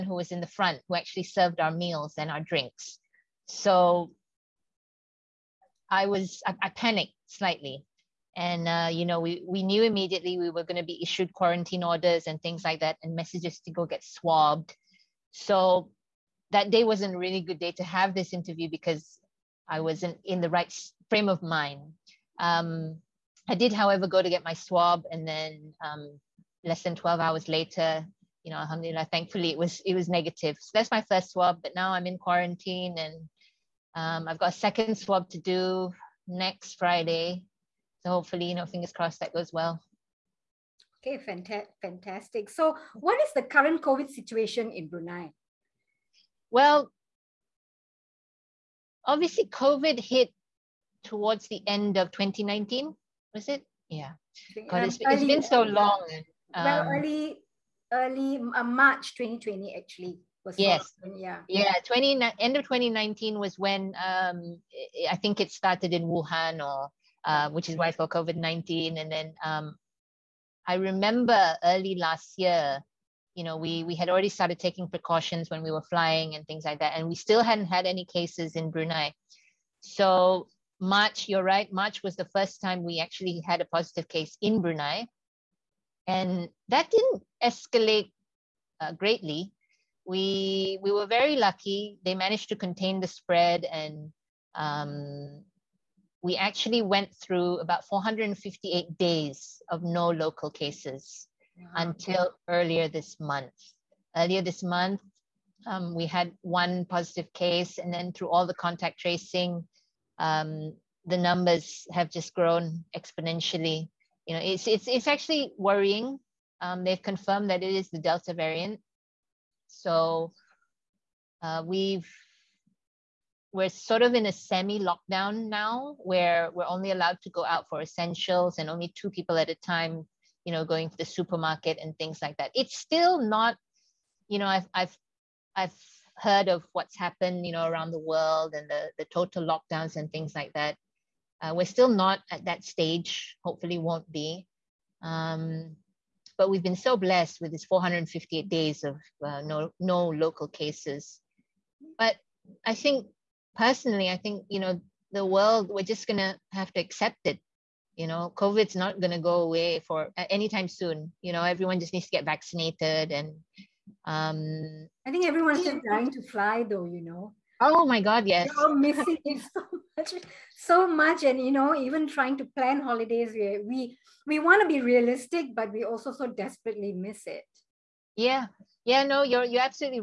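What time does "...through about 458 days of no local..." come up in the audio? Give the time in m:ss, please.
1:37.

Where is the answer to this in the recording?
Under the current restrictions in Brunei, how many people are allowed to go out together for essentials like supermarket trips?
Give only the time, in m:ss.
2:08.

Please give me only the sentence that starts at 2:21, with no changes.
Uh, we're still not at that stage.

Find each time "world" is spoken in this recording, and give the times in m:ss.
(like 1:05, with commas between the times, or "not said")
2:17, 2:35.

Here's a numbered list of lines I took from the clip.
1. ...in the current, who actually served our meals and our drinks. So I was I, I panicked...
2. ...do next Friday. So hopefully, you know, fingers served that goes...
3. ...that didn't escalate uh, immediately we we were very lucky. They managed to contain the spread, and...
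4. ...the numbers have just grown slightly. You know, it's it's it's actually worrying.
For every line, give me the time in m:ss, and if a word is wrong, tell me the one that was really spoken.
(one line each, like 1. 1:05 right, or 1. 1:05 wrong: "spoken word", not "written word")
1. 0:00 wrong: "front", not "current"
2. 0:35 wrong: "crossed", not "served"
3. 1:26 wrong: "greatly", not "immediately"
4. 1:51 wrong: "exponentially", not "slightly".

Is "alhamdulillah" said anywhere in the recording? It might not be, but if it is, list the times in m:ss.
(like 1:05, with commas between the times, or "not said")
0:28.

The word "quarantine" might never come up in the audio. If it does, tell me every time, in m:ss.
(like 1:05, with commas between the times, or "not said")
0:11, 0:32.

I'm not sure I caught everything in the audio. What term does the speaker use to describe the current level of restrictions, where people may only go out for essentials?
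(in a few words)
semi-lockdown.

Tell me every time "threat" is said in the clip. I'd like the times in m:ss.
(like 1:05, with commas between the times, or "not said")
not said.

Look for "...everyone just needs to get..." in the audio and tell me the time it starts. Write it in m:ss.
2:41.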